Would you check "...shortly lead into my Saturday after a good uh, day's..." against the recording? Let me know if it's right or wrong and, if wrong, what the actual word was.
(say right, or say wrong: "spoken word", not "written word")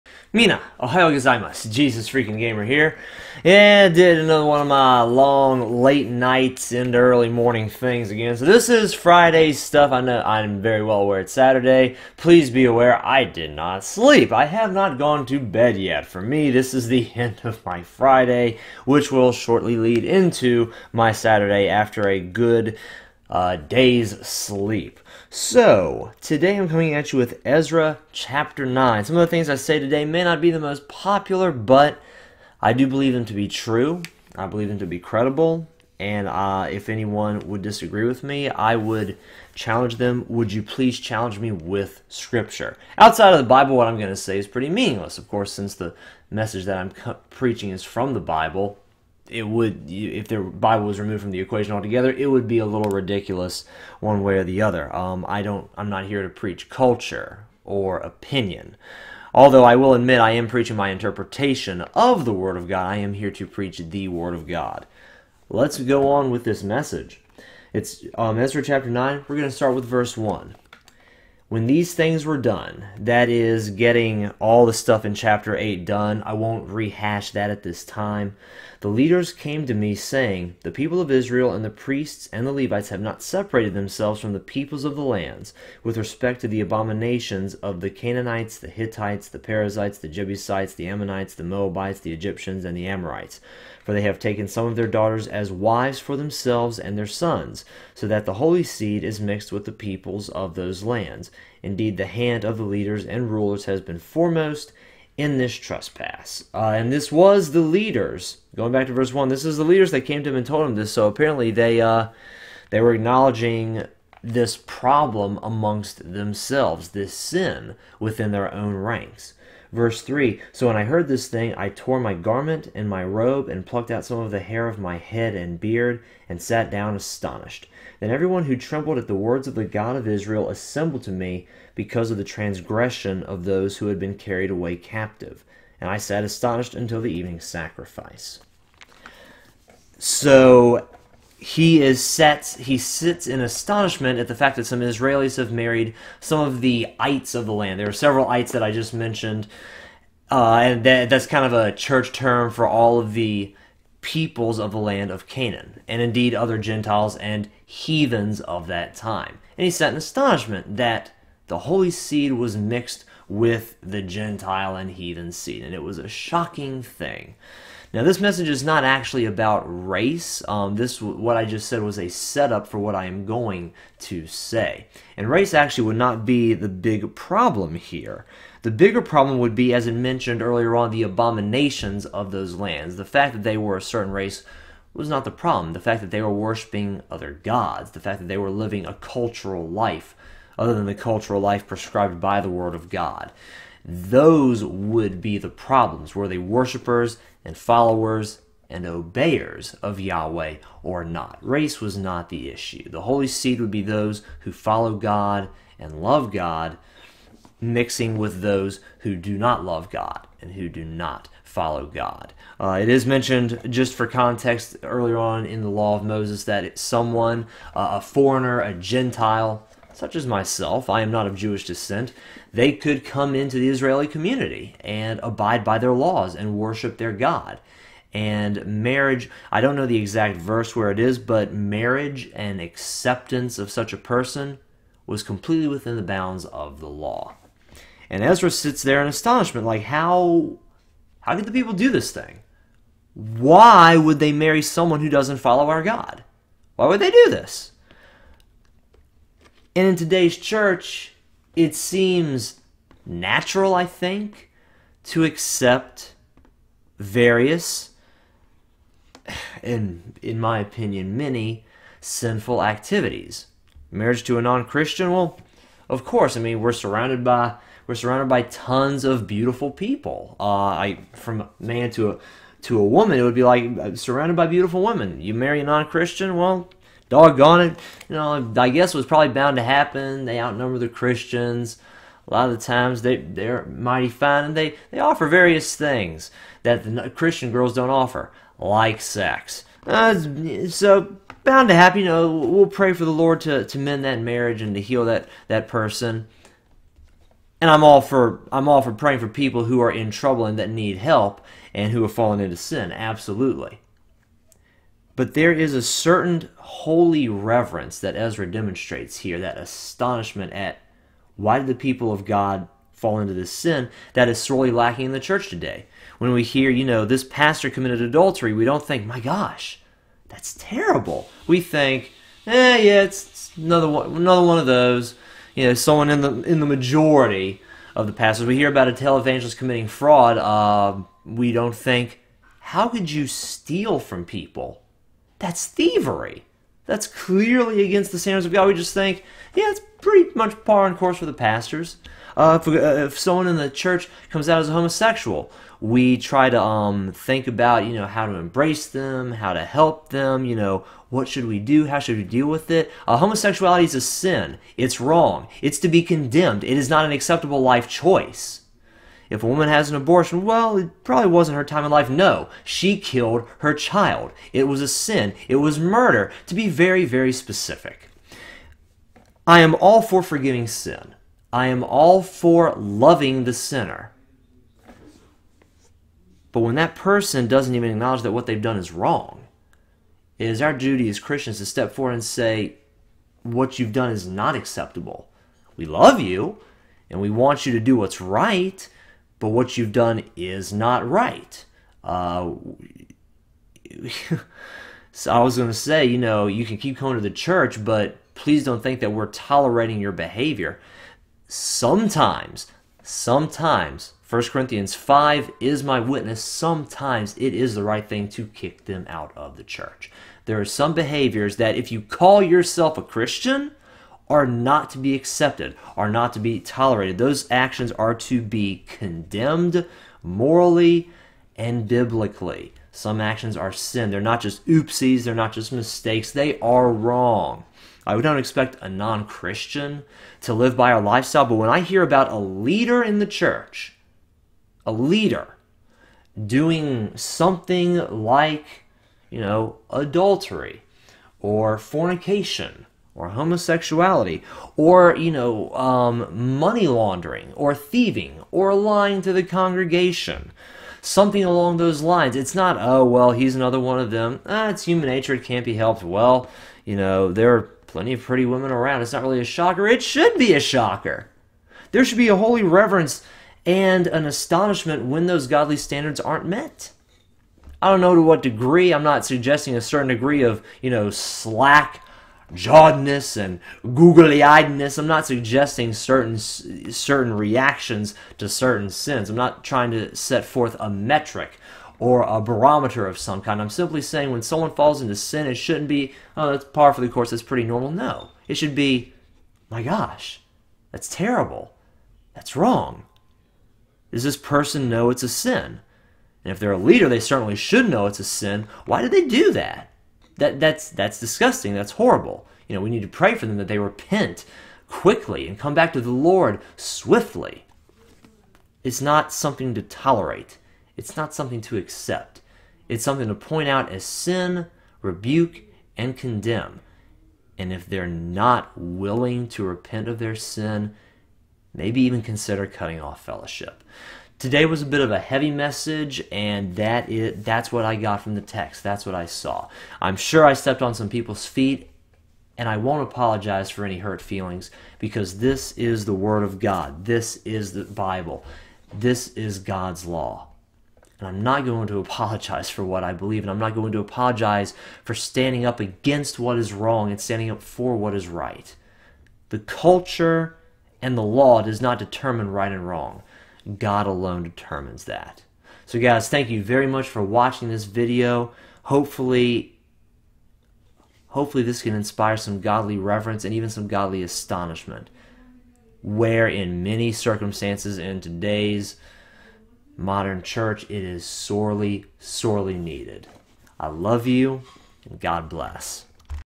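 right.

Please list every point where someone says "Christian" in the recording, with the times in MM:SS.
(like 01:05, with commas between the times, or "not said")
04:24, 04:35, 04:40, 04:47, 06:21, 06:53, 07:09.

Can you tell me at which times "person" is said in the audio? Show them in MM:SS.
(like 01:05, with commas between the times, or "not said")
03:53, 04:55, 06:16, 08:14.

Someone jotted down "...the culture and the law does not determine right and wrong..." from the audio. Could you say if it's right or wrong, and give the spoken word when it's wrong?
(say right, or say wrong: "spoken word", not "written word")
right.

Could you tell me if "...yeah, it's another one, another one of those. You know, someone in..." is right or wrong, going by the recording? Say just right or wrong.
right.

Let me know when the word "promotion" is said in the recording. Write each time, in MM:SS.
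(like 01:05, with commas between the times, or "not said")
not said.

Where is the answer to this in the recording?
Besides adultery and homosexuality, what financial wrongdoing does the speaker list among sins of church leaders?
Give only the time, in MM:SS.
07:26.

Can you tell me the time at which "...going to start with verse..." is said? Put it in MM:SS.
01:09.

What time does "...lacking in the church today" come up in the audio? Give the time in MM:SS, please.
05:14.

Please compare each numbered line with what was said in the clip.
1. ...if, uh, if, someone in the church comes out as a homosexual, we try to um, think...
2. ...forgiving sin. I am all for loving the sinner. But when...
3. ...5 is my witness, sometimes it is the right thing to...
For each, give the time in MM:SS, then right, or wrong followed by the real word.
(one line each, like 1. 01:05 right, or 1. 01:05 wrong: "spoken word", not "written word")
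1. 05:42 right
2. 06:10 right
3. 06:44 right.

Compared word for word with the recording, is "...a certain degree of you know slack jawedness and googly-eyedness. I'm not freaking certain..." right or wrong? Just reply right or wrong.
wrong.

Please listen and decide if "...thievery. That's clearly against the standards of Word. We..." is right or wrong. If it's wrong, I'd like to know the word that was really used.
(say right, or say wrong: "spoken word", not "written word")
wrong: "God", not "Word".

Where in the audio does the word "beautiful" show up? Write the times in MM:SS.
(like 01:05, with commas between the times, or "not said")
04:29, 04:34.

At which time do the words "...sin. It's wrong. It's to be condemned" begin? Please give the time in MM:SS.
05:54.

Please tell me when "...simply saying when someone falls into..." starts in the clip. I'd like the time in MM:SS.
08:03.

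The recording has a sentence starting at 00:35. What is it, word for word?
And uh, if anyone would disagree with me, I would challenge them.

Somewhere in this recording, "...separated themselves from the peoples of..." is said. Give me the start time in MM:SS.
01:23.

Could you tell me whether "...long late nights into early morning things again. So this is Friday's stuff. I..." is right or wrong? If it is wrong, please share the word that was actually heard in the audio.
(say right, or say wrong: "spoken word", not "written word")
right.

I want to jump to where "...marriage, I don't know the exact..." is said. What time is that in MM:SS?
03:48.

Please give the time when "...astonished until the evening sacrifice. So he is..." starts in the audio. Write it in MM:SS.
02:16.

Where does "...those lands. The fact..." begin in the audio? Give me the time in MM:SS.
03:02.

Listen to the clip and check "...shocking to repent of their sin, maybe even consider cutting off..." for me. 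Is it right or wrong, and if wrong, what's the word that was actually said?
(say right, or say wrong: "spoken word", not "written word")
wrong: "willing", not "shocking".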